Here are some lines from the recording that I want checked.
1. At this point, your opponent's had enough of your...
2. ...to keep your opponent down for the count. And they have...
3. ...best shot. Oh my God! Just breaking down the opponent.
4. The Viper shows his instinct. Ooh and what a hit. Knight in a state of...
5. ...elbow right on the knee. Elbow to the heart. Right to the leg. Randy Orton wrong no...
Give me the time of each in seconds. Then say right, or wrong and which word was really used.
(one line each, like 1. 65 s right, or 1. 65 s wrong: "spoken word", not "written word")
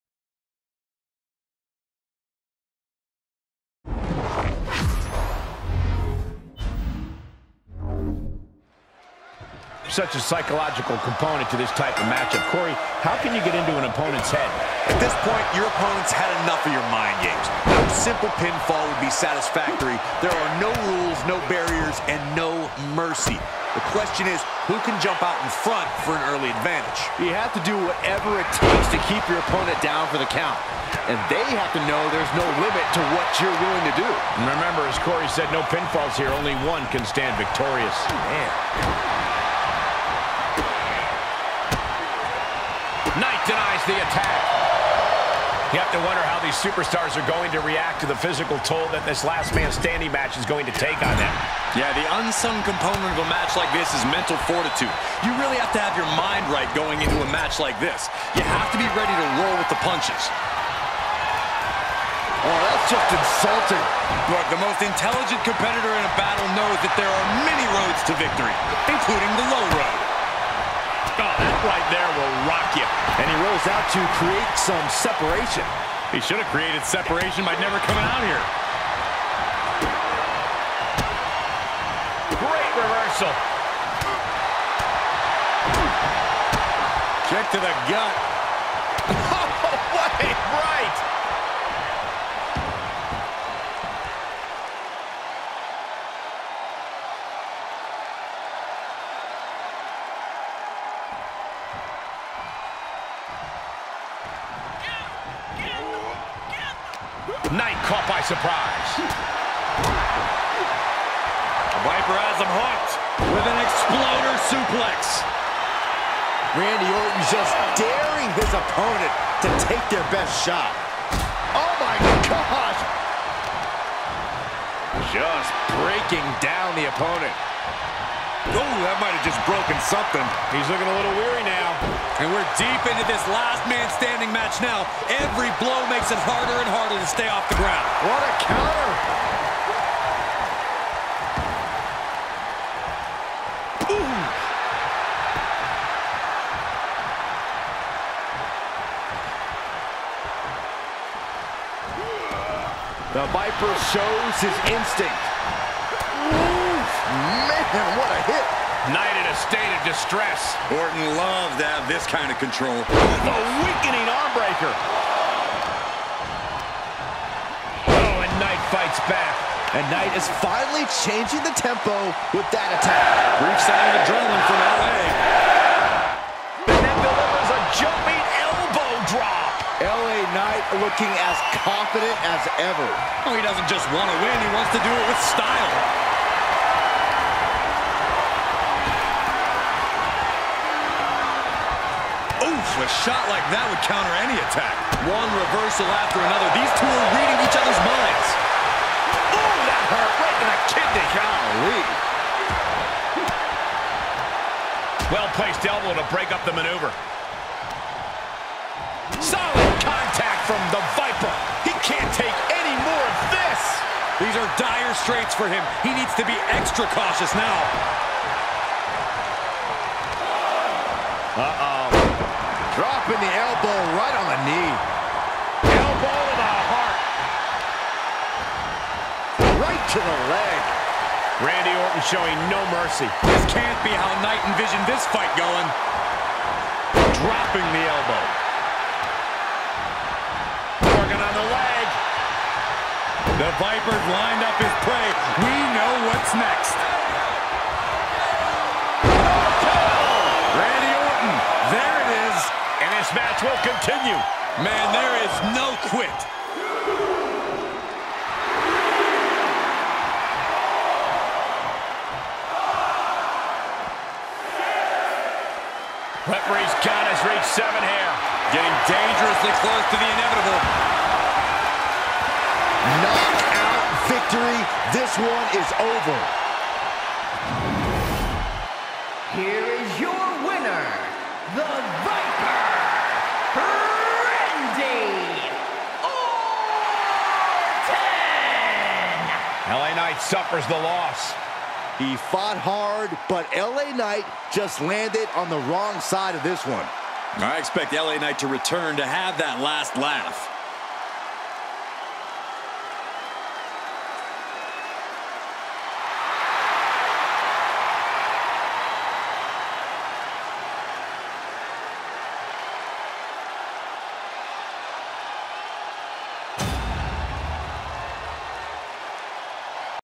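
1. 14 s right
2. 28 s right
3. 120 s right
4. 153 s right
5. 223 s wrong: "showing", not "wrong".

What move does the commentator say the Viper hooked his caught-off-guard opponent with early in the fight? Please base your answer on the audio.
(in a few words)
exploder suplex.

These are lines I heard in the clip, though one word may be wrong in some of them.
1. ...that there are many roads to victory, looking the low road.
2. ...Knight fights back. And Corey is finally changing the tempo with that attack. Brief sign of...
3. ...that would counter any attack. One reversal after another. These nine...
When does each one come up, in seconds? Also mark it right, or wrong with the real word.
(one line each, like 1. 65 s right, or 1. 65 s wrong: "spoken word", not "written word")
1. 66 s wrong: "including", not "looking"
2. 168 s wrong: "Knight", not "Corey"
3. 193 s wrong: "two", not "nine".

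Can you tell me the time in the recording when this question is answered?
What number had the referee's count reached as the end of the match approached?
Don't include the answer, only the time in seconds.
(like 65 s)
267 s.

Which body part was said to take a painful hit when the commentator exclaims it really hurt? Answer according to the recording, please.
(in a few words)
kidney.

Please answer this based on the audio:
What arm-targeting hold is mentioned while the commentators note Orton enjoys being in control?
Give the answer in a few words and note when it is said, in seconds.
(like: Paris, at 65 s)
arm breaker, at 164 s.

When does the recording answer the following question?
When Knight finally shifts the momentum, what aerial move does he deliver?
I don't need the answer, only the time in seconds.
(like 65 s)
177 s.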